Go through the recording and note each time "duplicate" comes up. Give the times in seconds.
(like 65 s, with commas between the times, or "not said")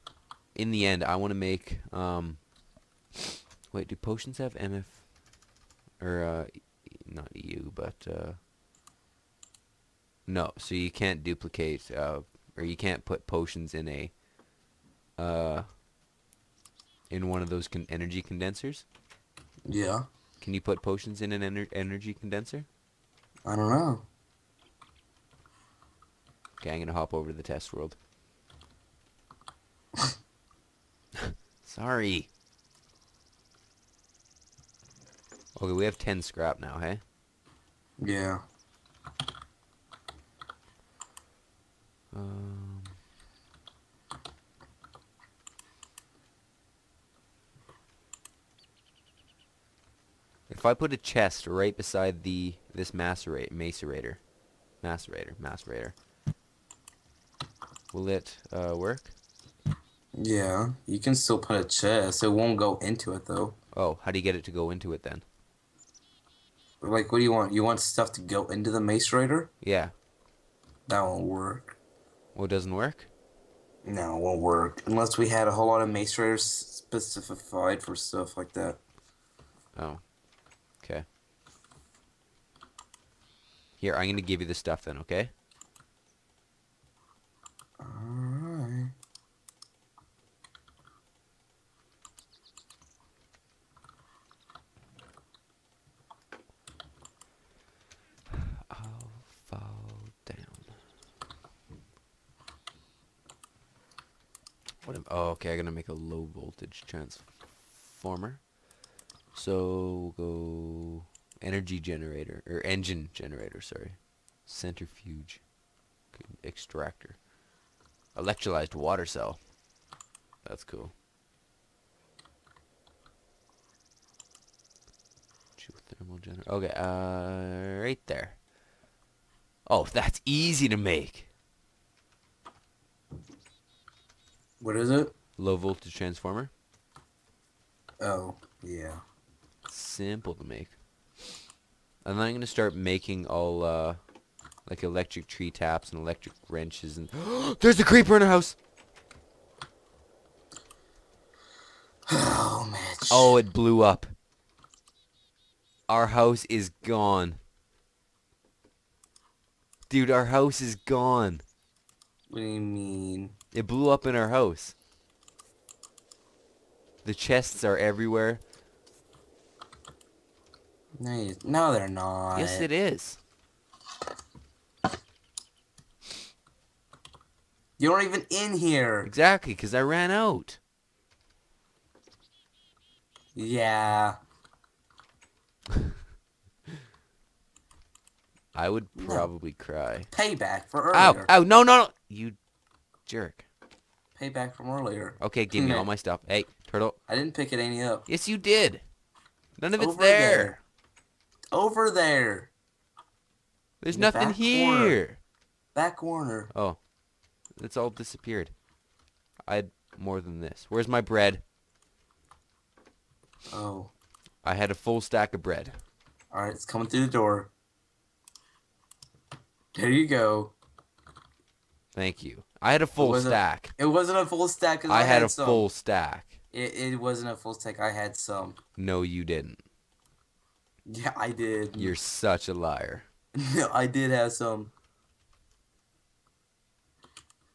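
11 s.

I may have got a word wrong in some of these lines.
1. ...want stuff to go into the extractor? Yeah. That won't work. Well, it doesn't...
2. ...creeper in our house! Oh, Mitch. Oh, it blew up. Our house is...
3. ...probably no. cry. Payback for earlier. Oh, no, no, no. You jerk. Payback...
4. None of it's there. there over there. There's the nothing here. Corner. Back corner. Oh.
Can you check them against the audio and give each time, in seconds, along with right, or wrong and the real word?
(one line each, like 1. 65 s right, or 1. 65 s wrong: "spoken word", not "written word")
1. 67 s wrong: "macerator", not "extractor"
2. 147 s right
3. 189 s right
4. 199 s right.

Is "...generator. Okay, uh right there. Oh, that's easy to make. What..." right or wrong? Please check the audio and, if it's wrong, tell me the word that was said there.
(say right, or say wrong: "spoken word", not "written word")
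right.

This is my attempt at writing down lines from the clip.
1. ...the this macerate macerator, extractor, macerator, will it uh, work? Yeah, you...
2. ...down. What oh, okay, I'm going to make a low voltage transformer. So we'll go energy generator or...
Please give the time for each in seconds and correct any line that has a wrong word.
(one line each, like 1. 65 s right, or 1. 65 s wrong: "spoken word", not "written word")
1. 52 s wrong: "macerator", not "extractor"
2. 100 s right.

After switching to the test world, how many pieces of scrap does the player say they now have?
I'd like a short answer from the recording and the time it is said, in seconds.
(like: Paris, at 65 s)
10, at 35 s.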